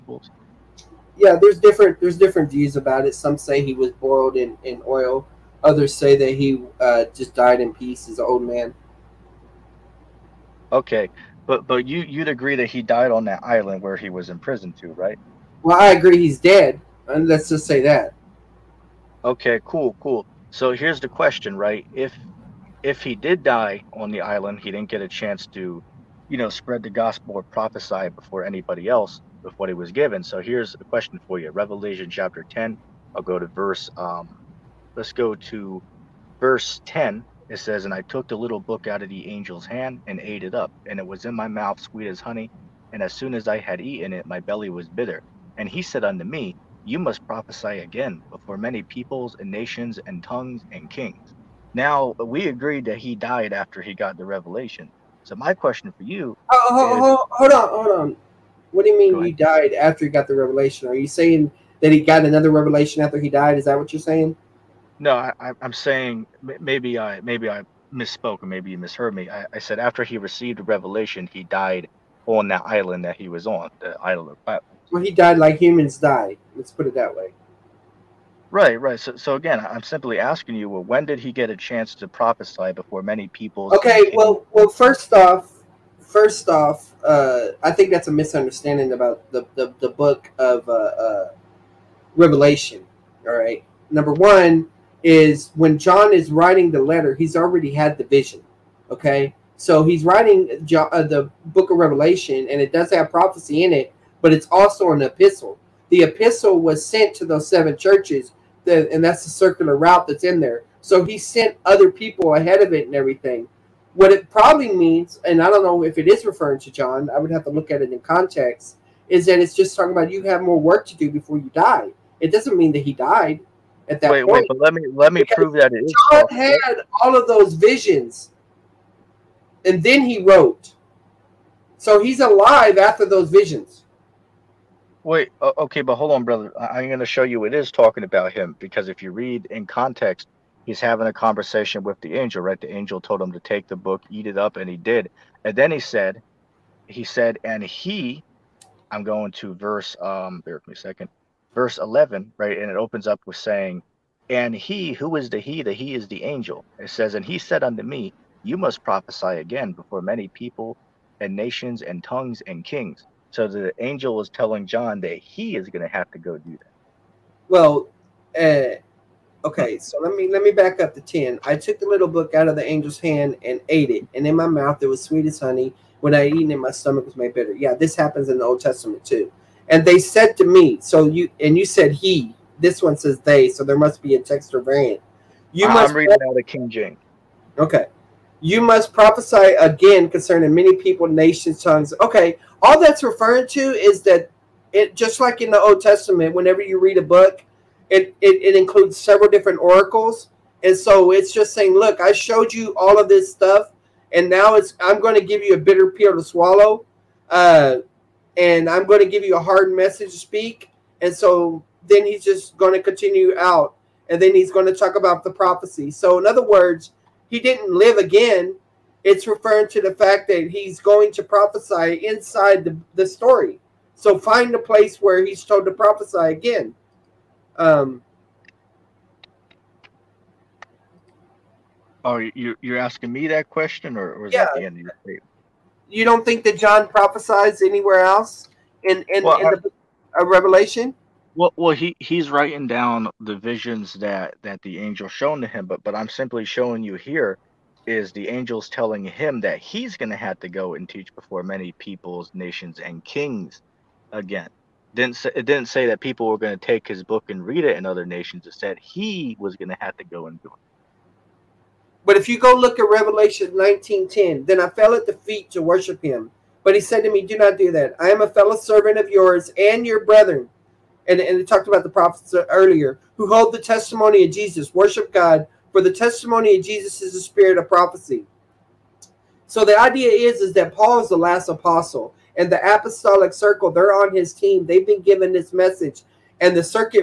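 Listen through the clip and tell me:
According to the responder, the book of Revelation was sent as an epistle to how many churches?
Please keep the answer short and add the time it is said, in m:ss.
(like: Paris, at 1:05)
7, at 1:47.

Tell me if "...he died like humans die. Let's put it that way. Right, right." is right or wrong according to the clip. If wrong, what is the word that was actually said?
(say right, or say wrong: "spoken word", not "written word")
right.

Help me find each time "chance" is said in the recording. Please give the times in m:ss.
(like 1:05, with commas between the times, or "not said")
0:25, 1:21.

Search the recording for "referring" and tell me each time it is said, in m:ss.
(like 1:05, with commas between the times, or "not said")
1:56, 3:13, 3:39.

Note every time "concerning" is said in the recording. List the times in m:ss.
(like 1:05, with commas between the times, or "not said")
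3:10.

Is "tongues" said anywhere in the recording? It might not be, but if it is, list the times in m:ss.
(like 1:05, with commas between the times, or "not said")
0:50, 2:42, 3:11.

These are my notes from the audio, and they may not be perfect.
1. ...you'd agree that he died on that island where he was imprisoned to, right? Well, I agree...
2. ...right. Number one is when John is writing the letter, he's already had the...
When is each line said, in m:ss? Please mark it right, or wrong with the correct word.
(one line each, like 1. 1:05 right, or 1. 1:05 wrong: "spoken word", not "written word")
1. 0:12 right
2. 1:33 right.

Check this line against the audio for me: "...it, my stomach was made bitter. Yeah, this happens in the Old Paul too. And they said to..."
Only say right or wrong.
wrong.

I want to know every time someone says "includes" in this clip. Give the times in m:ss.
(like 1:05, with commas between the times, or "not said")
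3:18.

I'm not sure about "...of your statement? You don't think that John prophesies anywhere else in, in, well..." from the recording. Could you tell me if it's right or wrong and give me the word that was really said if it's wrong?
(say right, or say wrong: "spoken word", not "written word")
right.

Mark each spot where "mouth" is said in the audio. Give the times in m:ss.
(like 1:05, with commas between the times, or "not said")
0:41, 2:54.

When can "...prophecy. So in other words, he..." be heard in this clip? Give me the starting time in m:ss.
3:35.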